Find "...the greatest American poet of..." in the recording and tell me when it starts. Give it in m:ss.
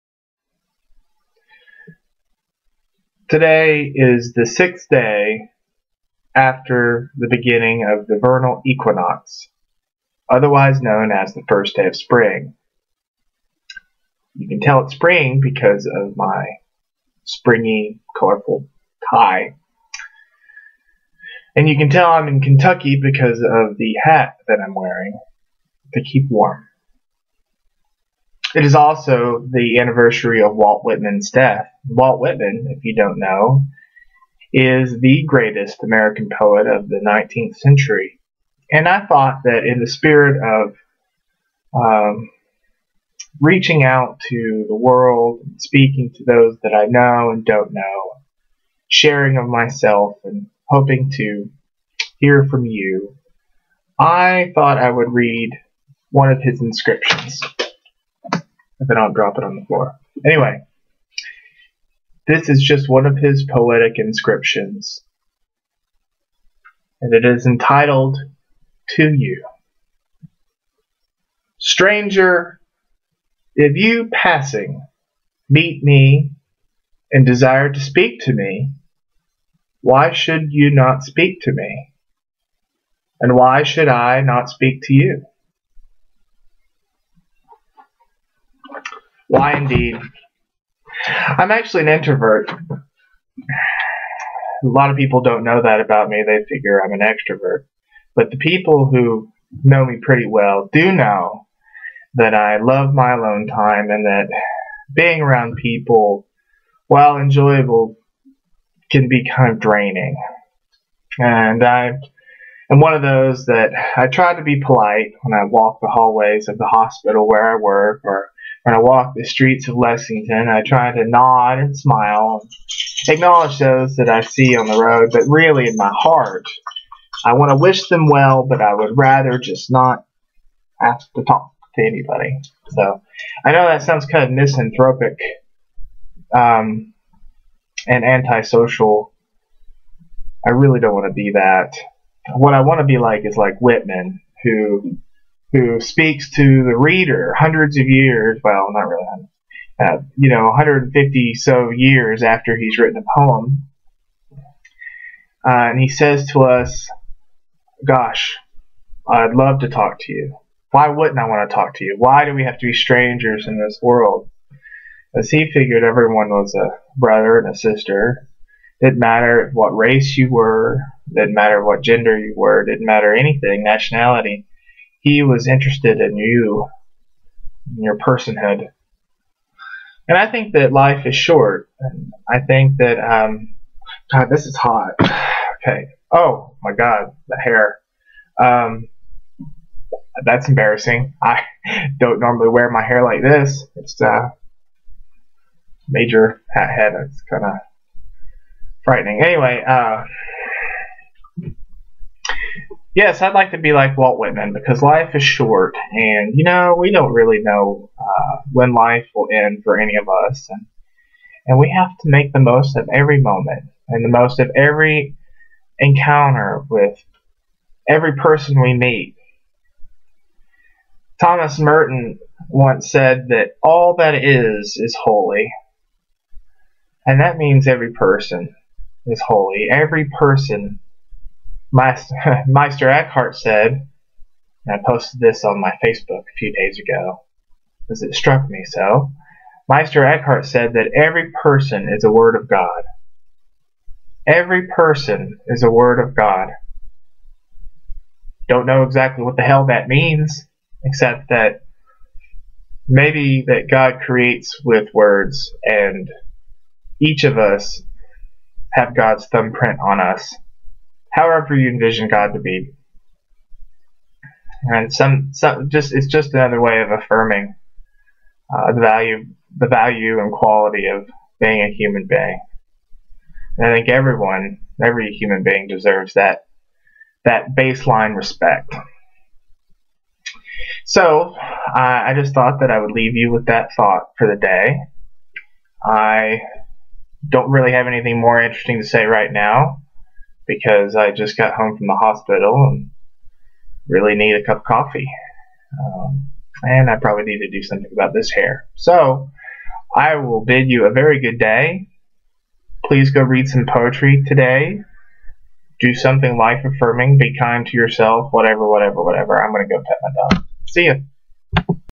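0:34.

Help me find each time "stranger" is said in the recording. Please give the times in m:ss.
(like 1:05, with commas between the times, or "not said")
1:11, 2:42.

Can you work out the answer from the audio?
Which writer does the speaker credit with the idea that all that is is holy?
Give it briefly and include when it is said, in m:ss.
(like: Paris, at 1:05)
Thomas Merton, at 3:41.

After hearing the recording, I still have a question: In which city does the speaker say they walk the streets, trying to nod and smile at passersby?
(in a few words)
Lexington.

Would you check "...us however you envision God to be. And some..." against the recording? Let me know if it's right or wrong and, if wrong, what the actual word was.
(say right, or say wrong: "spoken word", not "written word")
right.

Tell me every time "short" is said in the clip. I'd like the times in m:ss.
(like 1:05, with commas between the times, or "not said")
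3:01, 3:25.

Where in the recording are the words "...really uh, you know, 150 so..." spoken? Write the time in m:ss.
2:28.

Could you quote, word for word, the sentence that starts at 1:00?
Anyway, this is just one of his poetic inscriptions, and it is entitled To You.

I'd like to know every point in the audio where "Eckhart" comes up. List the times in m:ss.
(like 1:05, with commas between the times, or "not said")
3:52, 4:00.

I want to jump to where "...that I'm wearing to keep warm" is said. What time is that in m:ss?
0:24.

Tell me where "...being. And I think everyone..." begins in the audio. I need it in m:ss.
4:32.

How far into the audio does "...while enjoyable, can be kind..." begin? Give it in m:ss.
1:46.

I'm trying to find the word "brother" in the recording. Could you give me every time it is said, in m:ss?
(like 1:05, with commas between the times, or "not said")
2:46.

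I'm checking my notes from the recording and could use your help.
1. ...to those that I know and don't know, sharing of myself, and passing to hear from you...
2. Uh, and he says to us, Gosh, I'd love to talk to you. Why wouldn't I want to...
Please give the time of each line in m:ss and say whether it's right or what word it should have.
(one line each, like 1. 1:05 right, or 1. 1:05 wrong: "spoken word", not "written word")
1. 0:46 wrong: "hoping", not "passing"
2. 2:35 right.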